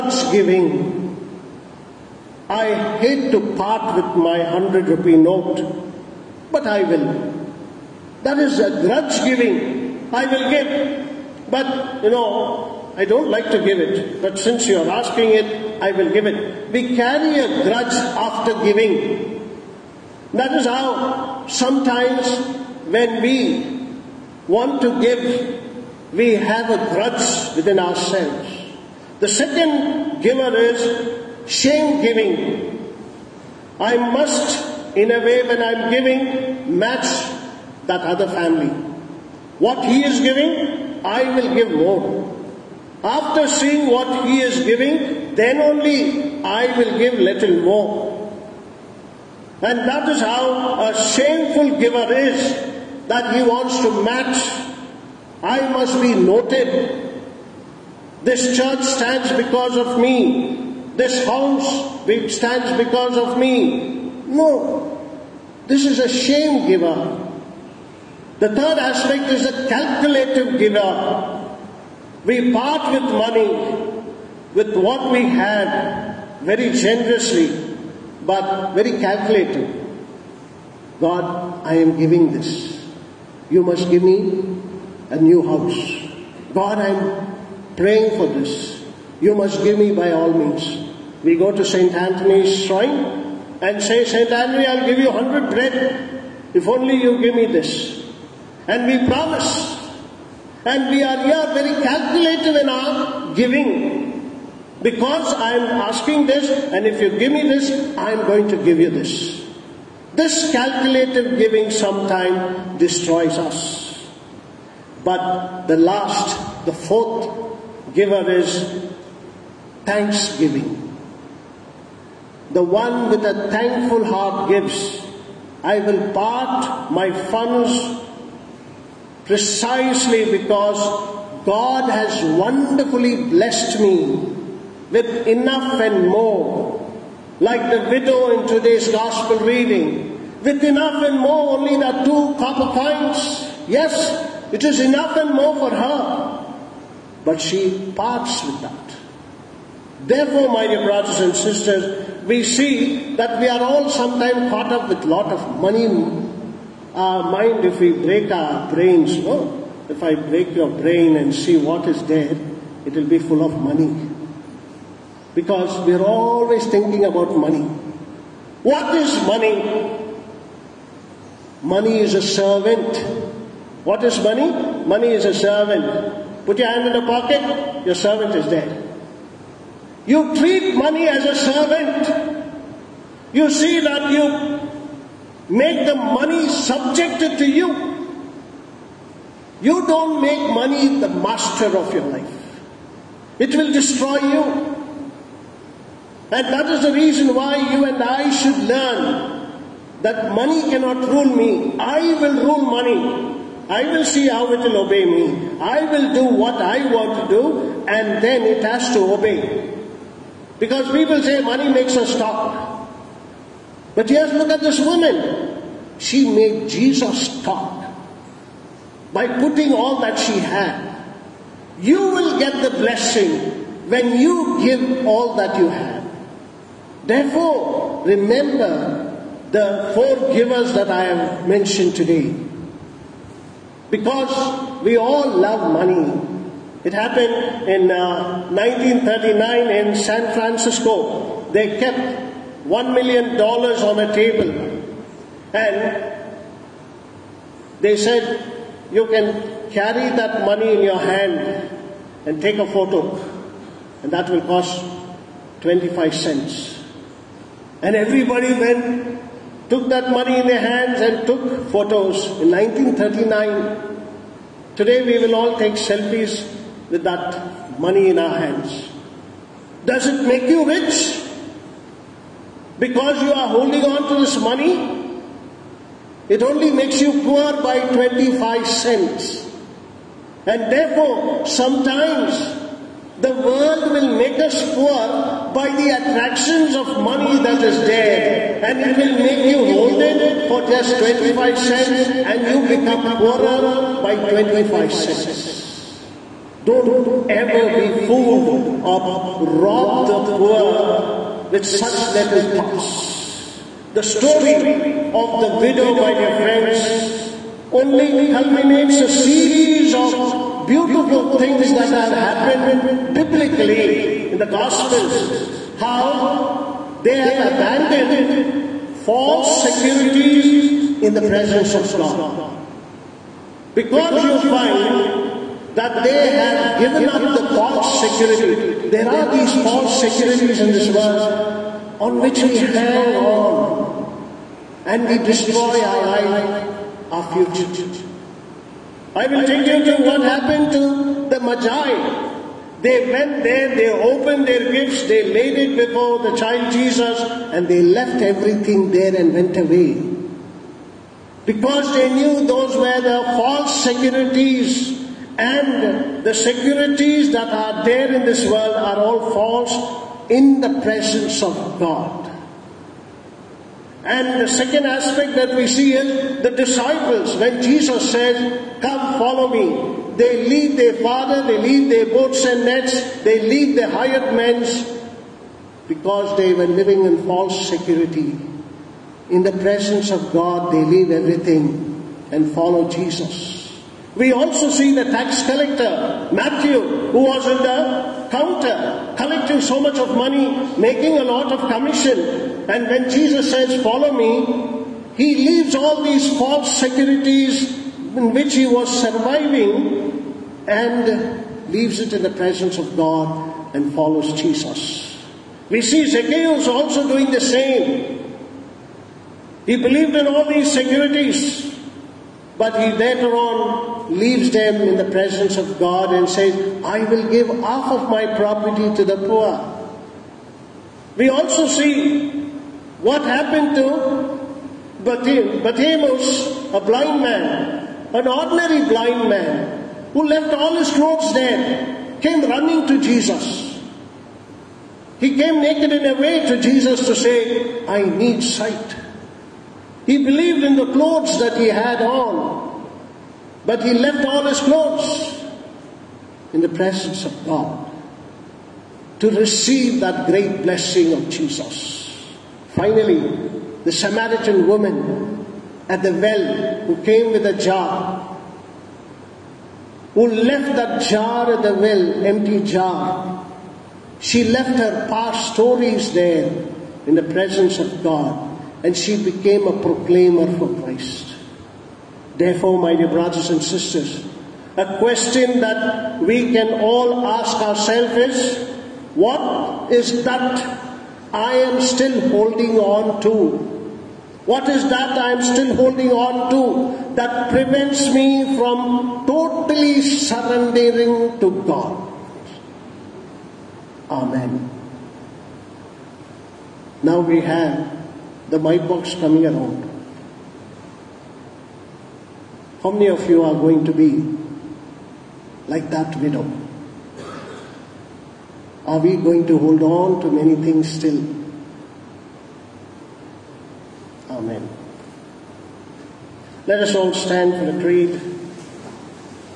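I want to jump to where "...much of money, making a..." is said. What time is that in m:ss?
6:29.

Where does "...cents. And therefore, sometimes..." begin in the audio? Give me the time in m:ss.
4:38.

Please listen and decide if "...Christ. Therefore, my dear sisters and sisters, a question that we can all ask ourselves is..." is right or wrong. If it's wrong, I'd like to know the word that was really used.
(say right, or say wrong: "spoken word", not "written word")
wrong: "brothers", not "sisters".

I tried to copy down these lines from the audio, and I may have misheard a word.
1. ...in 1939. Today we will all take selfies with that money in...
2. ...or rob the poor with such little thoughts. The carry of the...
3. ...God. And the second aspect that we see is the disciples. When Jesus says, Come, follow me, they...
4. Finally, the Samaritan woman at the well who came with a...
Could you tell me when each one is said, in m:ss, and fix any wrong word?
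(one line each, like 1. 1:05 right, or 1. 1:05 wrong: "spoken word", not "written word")
1. 4:22 right
2. 4:58 wrong: "story", not "carry"
3. 6:01 right
4. 7:32 right.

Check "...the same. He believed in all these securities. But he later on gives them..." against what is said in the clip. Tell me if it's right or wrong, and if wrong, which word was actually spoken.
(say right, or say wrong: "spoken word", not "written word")
wrong: "leaves", not "gives".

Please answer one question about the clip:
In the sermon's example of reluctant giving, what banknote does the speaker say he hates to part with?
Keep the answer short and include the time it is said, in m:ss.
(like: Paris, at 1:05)
100 rupee note, at 0:04.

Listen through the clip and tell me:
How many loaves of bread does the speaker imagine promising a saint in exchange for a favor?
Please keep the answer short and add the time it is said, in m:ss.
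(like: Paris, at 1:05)
100, at 1:35.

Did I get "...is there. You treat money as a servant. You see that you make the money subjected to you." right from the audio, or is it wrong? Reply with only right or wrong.
right.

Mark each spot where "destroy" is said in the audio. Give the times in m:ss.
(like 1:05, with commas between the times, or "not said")
1:52, 3:13, 5:35.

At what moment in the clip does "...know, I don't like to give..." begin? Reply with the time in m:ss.
0:12.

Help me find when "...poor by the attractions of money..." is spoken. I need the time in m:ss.
4:44.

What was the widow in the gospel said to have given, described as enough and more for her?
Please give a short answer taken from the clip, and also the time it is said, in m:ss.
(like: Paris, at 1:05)
two copper coins, at 2:22.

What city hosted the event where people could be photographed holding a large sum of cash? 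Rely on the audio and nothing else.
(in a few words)
San Francisco.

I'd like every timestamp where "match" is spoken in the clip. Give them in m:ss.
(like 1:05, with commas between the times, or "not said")
0:36, 0:54.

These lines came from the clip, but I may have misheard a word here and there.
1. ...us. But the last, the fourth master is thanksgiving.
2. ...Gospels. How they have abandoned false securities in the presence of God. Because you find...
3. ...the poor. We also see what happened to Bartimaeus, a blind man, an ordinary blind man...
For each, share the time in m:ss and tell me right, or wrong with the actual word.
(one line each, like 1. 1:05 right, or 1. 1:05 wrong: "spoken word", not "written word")
1. 1:53 wrong: "giver", not "master"
2. 5:14 right
3. 6:59 right.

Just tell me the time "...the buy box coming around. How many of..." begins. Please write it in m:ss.
8:18.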